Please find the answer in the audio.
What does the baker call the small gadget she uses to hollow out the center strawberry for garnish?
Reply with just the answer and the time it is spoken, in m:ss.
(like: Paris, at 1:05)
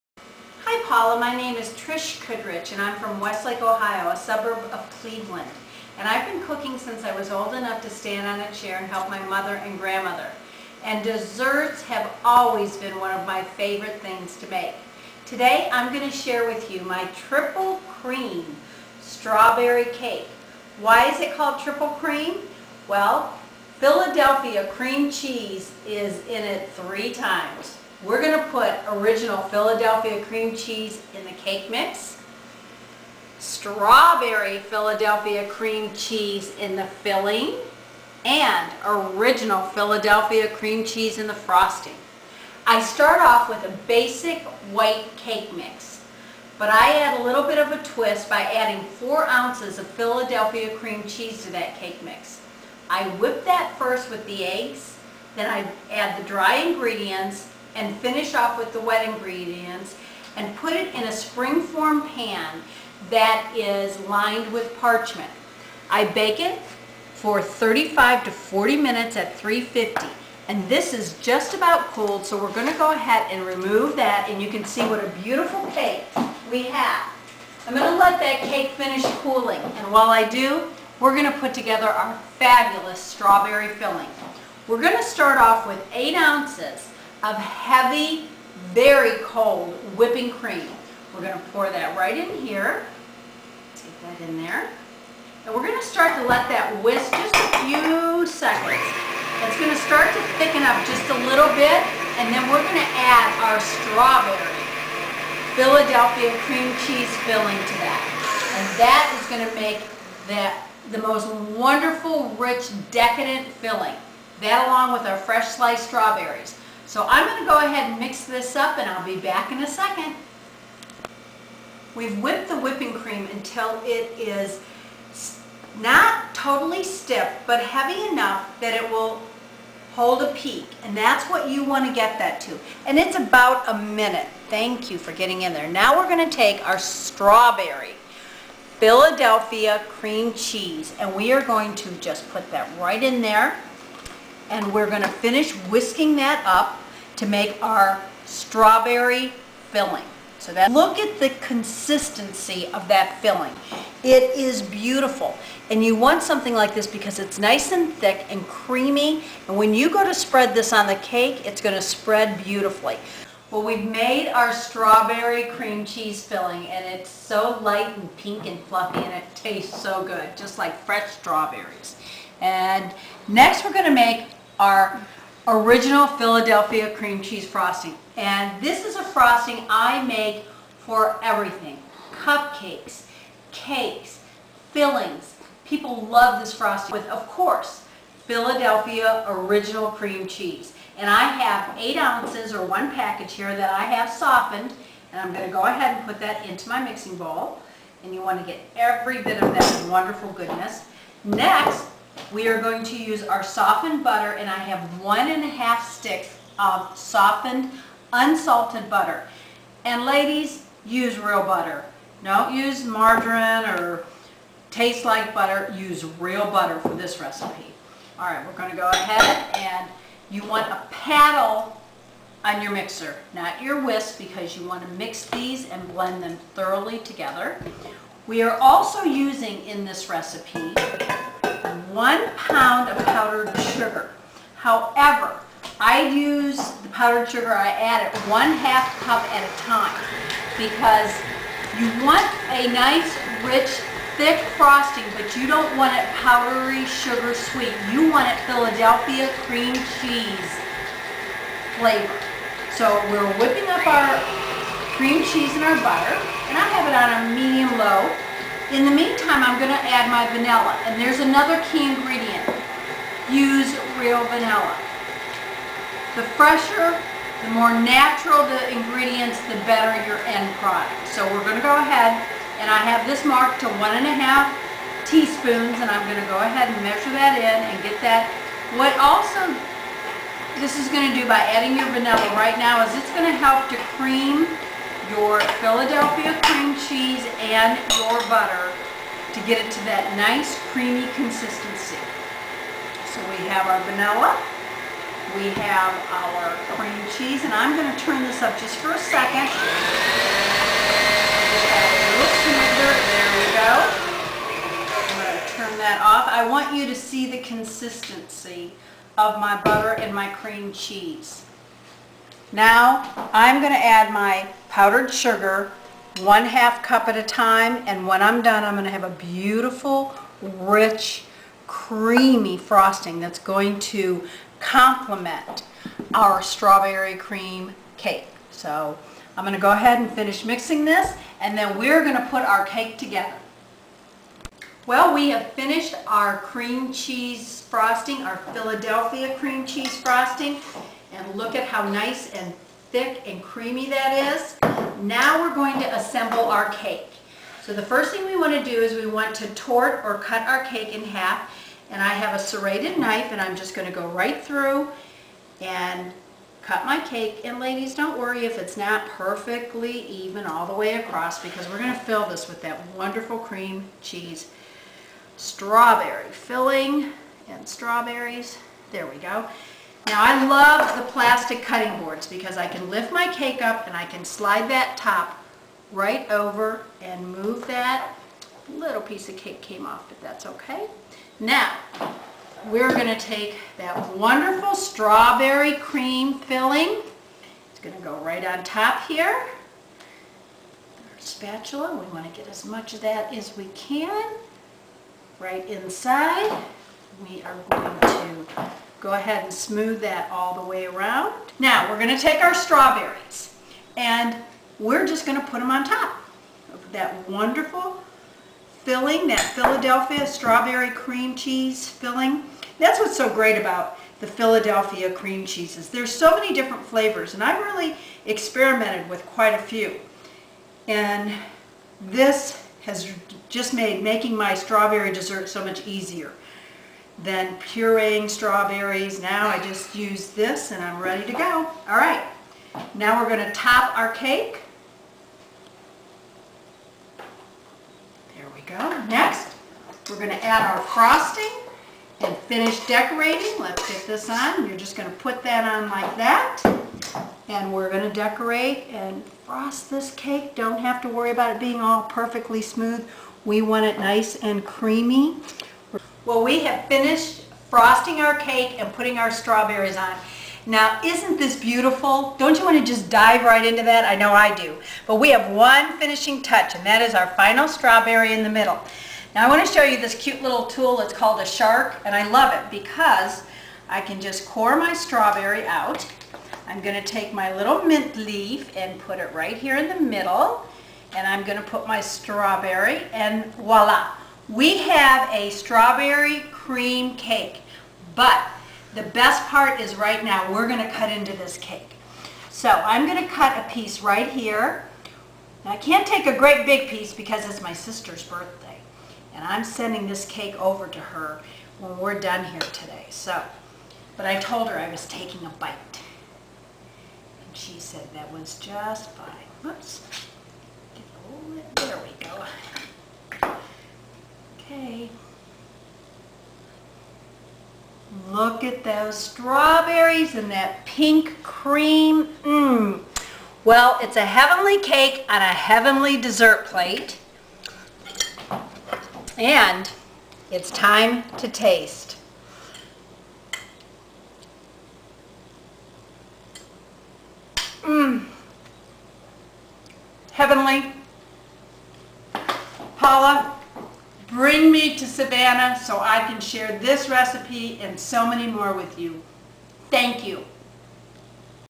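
a shark, at 7:51.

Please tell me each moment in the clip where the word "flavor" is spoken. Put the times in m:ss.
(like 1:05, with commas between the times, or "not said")
4:11, 6:56.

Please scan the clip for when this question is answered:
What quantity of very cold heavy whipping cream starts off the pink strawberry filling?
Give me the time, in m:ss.
1:25.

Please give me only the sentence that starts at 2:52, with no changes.
And next we're going to make our original Philadelphia cream cheese frosting.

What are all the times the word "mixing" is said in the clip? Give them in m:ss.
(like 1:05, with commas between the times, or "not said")
3:16, 5:30.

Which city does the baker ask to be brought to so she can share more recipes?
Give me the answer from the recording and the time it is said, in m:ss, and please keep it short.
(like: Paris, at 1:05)
Savannah, at 9:05.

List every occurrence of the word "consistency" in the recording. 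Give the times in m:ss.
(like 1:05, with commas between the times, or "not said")
2:31, 4:51, 5:07.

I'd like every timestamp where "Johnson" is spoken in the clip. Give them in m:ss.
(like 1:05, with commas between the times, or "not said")
not said.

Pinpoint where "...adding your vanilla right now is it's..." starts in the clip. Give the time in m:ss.
4:41.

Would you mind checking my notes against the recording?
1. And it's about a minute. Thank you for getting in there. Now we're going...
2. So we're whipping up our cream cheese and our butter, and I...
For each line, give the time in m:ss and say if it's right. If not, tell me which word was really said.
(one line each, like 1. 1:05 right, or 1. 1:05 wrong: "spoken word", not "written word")
1. 2:12 right
2. 4:12 right.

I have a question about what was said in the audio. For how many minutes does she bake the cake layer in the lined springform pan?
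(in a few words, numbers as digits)
35 to 40 minutes.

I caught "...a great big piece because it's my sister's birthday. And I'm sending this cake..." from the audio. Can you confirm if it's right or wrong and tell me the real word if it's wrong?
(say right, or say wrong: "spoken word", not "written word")
right.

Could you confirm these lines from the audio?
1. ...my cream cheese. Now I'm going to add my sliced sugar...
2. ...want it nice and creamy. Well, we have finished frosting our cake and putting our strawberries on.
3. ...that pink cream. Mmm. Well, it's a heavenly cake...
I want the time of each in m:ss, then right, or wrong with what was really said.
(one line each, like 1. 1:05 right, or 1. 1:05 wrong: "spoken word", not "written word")
1. 5:10 wrong: "powdered", not "sliced"
2. 7:33 right
3. 8:40 right.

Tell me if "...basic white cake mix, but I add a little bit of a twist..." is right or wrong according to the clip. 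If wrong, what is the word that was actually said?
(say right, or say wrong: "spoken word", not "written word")
right.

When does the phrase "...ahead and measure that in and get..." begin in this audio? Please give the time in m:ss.
4:36.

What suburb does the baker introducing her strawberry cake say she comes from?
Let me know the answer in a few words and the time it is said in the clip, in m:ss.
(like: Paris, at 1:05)
Westlake, Ohio, at 0:03.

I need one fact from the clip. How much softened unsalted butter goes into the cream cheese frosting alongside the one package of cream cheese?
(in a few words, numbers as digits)
1 and a half sticks.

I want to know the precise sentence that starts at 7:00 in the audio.
And this has just made making my strawberry dessert so much easier than pureeing strawberries.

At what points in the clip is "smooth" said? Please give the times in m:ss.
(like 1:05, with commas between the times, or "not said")
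6:39, 7:32.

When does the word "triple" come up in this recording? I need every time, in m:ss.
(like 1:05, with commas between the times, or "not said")
0:17, 0:21.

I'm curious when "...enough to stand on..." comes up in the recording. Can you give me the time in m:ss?
0:07.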